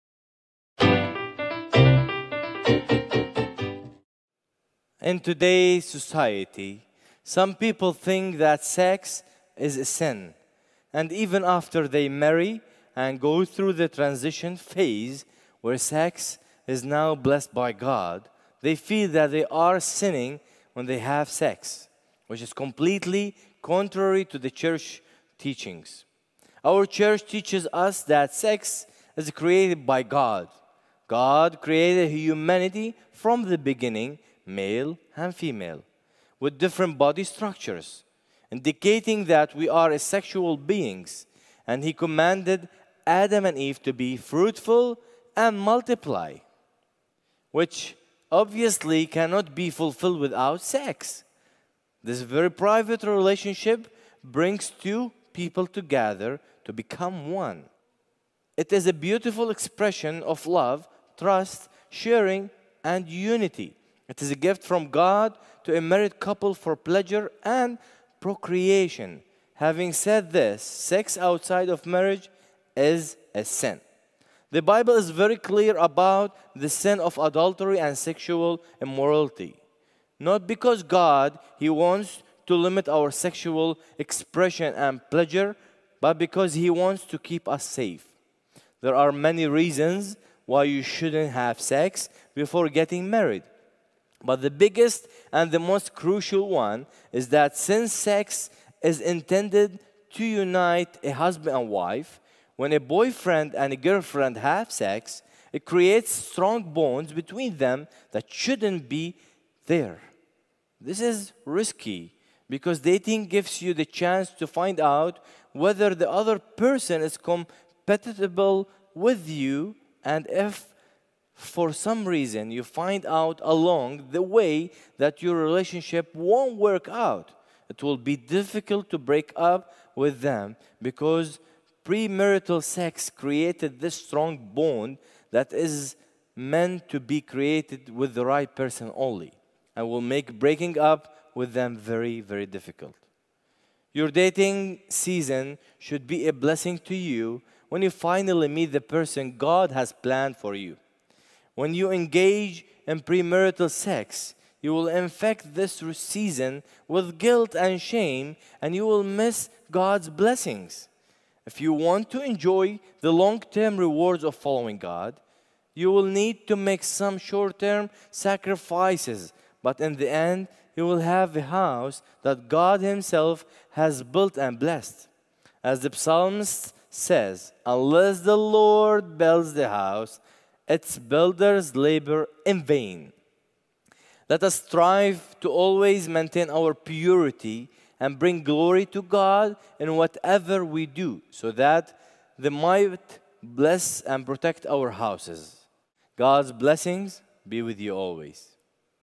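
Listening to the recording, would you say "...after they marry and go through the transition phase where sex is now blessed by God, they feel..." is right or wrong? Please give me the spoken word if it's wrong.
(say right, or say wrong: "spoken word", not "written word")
right.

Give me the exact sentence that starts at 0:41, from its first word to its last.
And he commanded Adam and Eve to be fruitful and multiply, which obviously cannot be fulfilled without sex.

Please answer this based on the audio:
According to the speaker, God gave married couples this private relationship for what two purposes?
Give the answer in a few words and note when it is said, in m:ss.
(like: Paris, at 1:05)
pleasure and procreation, at 1:06.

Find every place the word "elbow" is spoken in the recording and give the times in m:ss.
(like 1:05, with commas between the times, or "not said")
not said.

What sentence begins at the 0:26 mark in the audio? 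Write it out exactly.
Our church teaches us that sex is created by God.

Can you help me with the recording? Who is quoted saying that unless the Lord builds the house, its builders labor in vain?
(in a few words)
the psalmist.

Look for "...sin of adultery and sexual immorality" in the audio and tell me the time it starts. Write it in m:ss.
1:16.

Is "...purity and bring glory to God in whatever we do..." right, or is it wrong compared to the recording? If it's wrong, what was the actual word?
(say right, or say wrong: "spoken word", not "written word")
right.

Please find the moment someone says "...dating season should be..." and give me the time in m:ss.
2:24.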